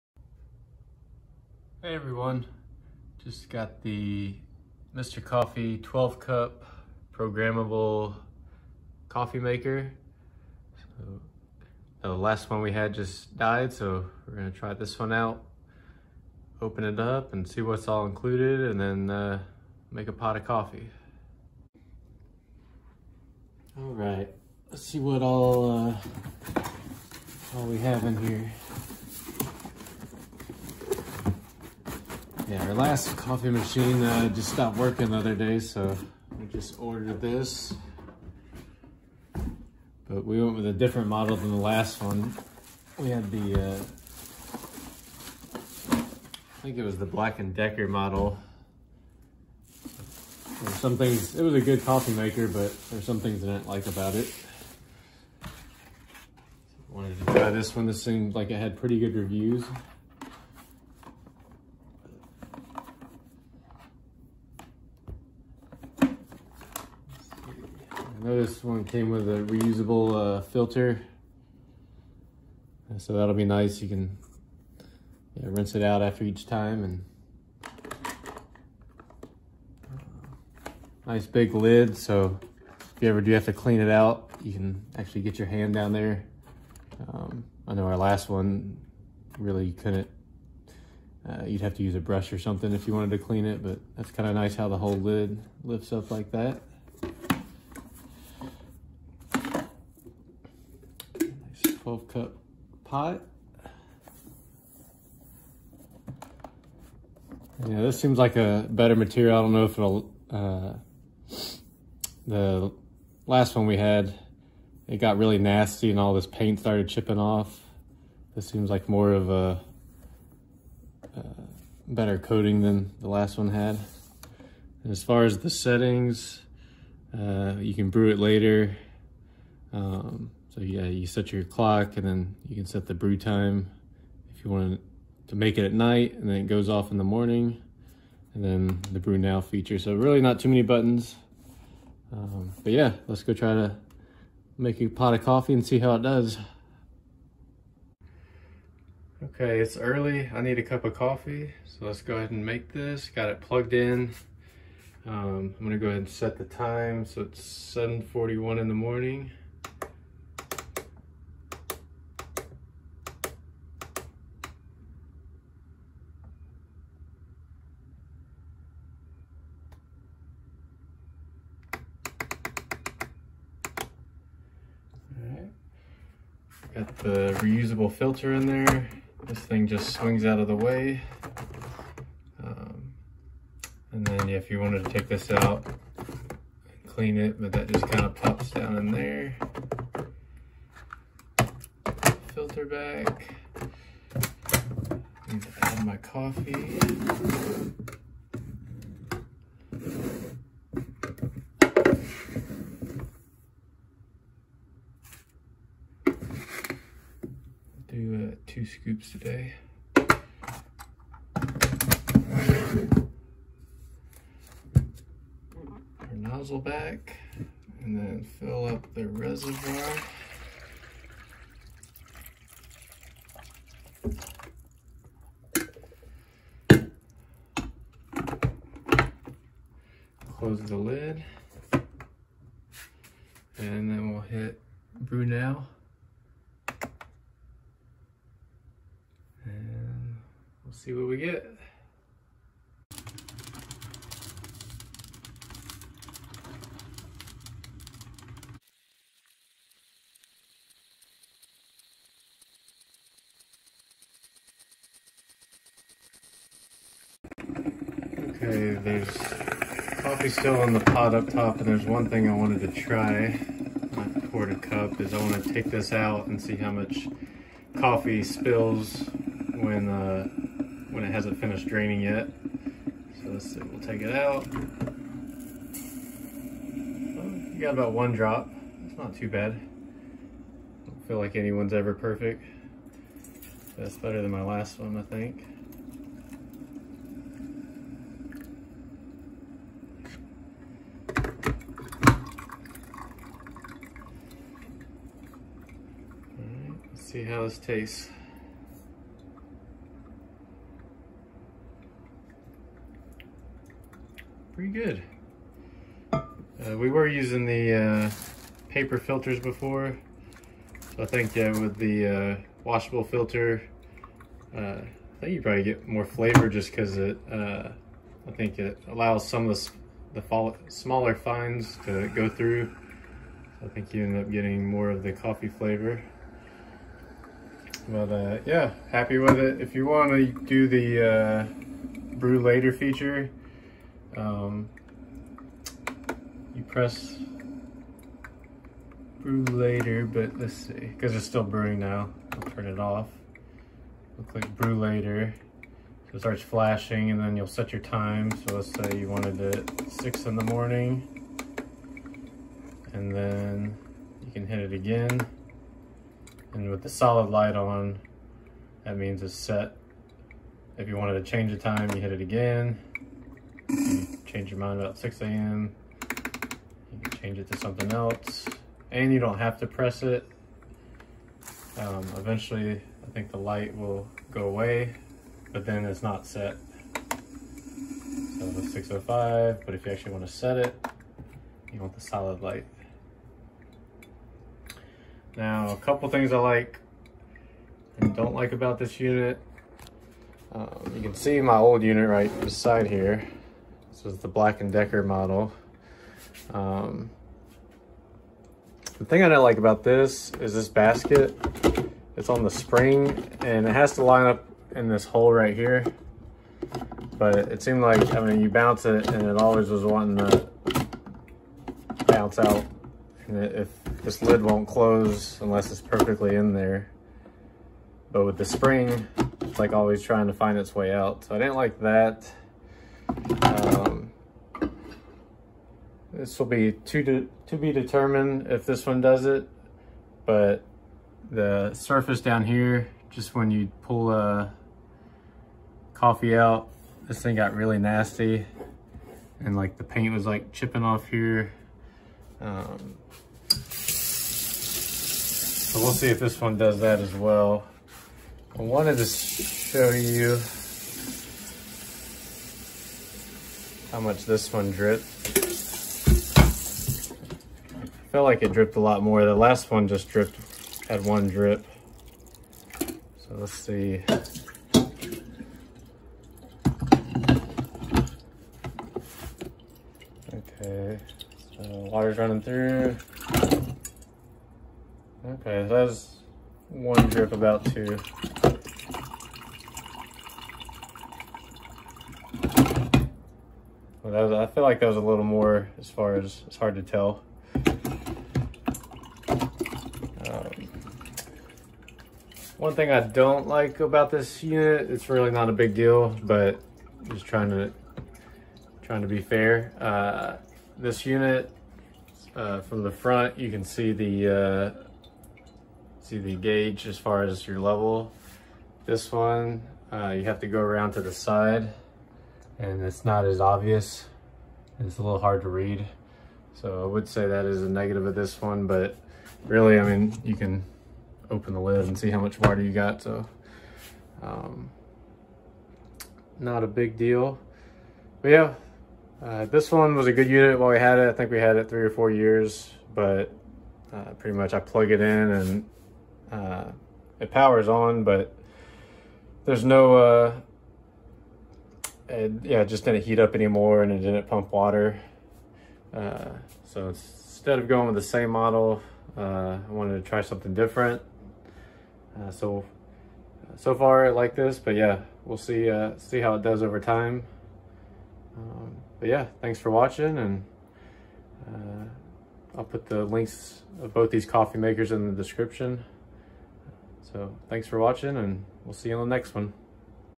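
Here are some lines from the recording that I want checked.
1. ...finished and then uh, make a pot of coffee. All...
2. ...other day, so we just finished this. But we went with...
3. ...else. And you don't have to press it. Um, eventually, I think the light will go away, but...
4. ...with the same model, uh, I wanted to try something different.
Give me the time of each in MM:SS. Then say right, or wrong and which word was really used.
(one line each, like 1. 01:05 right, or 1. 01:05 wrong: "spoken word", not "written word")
1. 00:18 wrong: "included", not "finished"
2. 00:35 wrong: "ordered", not "finished"
3. 06:07 right
4. 09:07 right.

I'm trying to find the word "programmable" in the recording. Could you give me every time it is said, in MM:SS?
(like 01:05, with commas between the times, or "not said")
00:07.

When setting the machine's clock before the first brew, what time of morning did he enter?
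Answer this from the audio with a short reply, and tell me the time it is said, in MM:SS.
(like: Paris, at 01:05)
7:41, at 02:37.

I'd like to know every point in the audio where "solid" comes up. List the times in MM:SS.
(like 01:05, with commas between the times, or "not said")
05:56, 06:22.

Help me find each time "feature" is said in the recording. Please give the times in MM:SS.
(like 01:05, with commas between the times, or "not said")
02:19, 05:32.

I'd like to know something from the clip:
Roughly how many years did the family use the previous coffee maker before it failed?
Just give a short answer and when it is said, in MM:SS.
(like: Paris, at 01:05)
3 or 4 years, at 08:51.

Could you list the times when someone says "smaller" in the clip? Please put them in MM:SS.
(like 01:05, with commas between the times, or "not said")
05:20.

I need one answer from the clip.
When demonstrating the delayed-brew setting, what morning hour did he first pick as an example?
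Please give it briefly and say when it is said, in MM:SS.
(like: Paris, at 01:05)
6 a.m., at 05:49.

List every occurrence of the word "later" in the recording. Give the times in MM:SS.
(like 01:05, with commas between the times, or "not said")
02:08, 05:32, 05:39, 05:44.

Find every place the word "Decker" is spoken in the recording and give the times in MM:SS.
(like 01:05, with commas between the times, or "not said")
00:47, 06:34.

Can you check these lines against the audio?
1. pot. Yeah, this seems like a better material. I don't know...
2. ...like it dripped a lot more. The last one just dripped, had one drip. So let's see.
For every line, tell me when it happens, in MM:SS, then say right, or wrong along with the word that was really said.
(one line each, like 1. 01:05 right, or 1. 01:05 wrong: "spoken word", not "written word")
1. 01:42 right
2. 07:38 right.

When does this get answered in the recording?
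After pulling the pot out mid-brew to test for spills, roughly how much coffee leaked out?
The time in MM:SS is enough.
04:37.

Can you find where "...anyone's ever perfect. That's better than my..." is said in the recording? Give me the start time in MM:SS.
04:41.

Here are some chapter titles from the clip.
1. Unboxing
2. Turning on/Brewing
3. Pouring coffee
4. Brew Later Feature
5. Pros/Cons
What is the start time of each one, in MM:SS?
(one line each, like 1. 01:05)
1. 00:21
2. 02:28
3. 04:28
4. 05:29
5. 06:24.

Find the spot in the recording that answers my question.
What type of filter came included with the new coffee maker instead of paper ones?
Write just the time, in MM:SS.
01:09.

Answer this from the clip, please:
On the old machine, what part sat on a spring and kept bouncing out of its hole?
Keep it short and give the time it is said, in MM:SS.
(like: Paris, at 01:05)
basket, at 06:40.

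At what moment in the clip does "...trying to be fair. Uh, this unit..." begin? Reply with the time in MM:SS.
08:18.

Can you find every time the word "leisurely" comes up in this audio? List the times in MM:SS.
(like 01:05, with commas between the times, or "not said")
not said.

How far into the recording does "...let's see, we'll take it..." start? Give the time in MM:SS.
04:33.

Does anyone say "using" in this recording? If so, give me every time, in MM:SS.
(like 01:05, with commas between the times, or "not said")
05:07.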